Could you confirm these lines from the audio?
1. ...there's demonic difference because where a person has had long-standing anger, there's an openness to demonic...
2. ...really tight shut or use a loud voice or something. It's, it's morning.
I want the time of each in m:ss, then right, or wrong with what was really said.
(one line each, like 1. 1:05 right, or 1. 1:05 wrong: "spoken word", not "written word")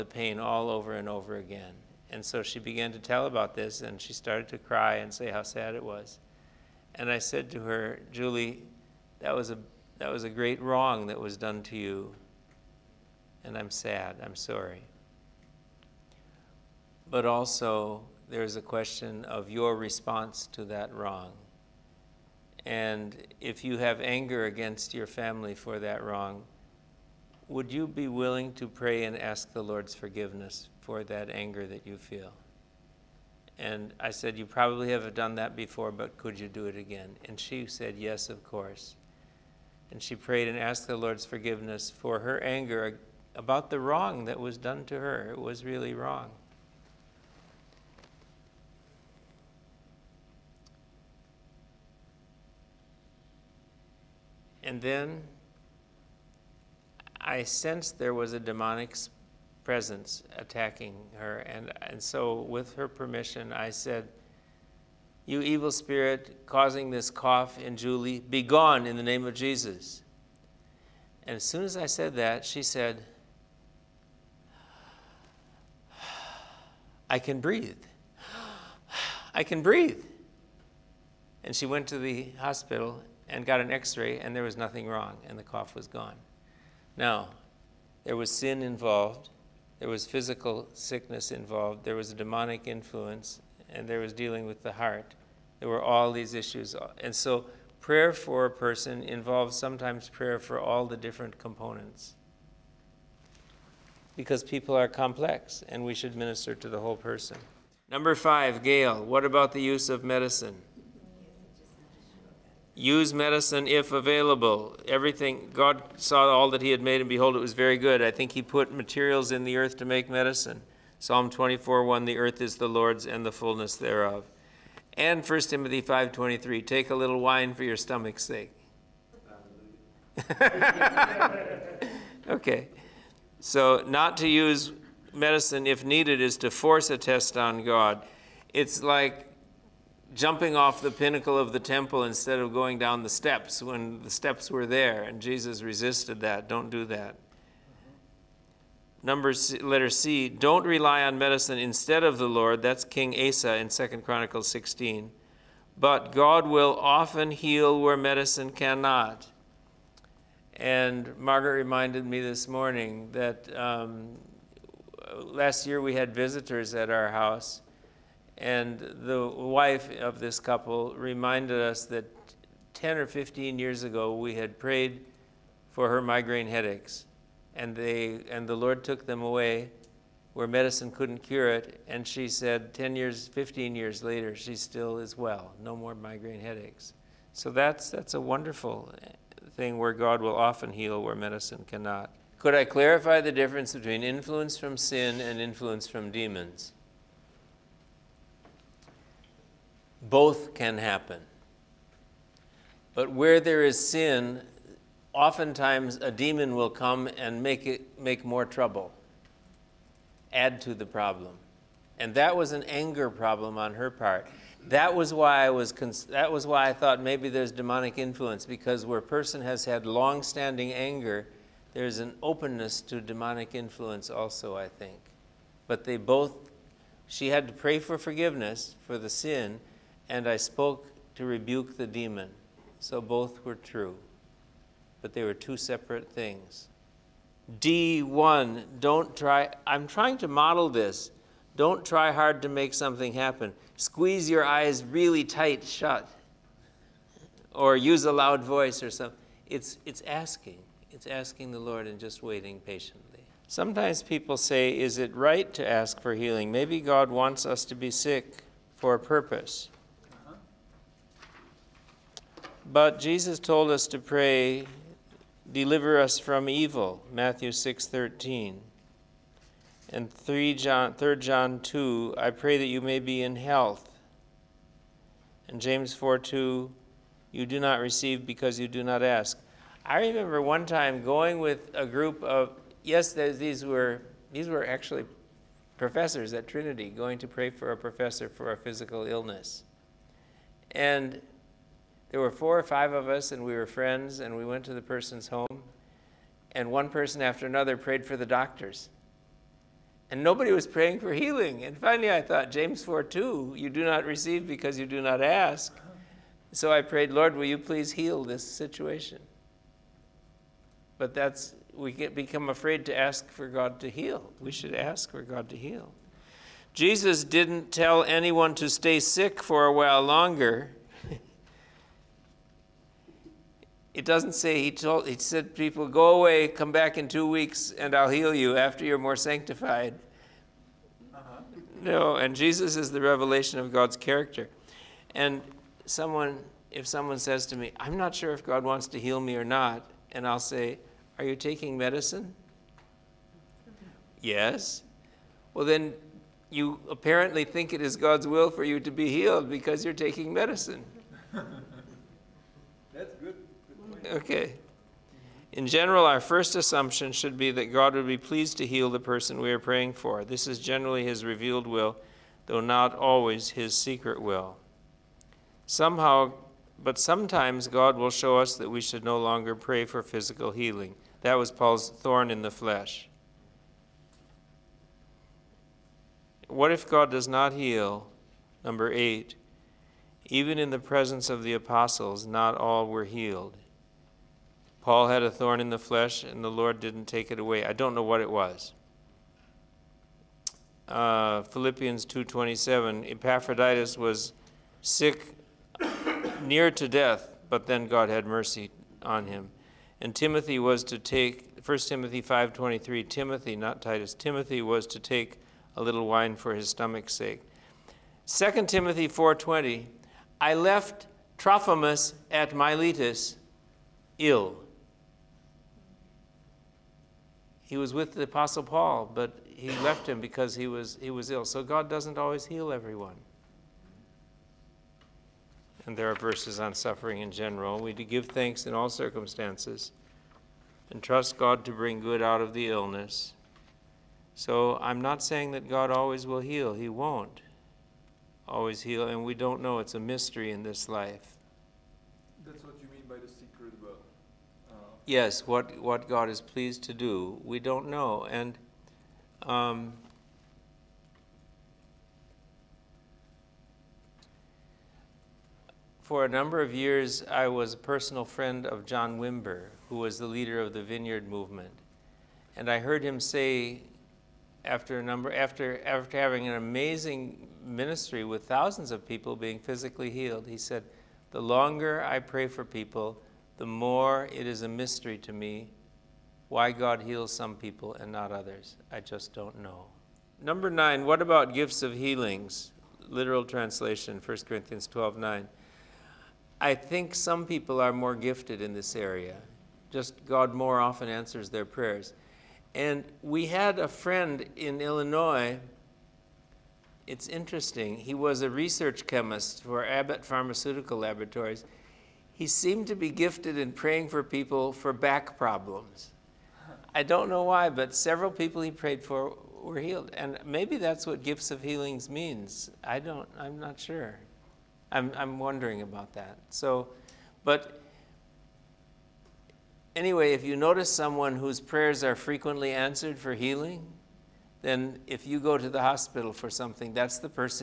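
1. 3:37 wrong: "influence", not "difference"
2. 4:04 wrong: "asking", not "morning".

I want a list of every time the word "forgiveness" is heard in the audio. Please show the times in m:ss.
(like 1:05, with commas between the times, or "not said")
0:29, 0:41, 3:47.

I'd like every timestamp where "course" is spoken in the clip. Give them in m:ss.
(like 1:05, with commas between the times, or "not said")
0:38.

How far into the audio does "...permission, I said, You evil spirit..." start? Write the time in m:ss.
1:02.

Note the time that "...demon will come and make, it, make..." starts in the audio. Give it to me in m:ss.
3:26.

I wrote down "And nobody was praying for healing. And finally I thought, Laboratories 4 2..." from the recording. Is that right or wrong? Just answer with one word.
wrong.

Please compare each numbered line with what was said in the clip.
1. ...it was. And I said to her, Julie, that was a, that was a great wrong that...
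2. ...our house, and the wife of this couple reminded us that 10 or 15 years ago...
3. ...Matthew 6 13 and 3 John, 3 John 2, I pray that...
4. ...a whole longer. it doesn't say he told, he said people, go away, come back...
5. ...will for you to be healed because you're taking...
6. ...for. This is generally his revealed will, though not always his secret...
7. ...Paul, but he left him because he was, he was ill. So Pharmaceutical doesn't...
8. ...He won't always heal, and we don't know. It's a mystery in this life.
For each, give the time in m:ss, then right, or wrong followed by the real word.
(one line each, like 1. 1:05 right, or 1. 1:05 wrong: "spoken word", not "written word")
1. 0:05 right
2. 2:46 right
3. 4:27 right
4. 5:19 wrong: "while", not "whole"
5. 5:48 right
6. 5:59 right
7. 6:58 wrong: "God", not "Pharmaceutical"
8. 7:16 right.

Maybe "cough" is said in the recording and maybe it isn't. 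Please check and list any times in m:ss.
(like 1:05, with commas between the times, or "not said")
1:07, 1:25.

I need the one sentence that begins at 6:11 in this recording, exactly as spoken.
That was Paul's thorn in the flesh.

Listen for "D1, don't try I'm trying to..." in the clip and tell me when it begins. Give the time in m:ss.
3:57.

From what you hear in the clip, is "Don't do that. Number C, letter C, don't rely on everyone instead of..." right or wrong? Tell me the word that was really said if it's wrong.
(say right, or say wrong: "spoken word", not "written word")
wrong: "medicine", not "everyone".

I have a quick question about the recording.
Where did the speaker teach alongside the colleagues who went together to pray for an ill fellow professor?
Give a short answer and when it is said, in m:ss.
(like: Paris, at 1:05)
Trinity, at 4:46.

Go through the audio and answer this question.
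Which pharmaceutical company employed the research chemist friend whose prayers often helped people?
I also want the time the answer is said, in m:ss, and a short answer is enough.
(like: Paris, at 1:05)
Abbott, at 8:19.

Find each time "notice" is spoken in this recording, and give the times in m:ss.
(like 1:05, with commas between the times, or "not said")
8:40.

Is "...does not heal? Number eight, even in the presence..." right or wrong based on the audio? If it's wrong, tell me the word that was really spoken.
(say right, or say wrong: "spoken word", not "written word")
right.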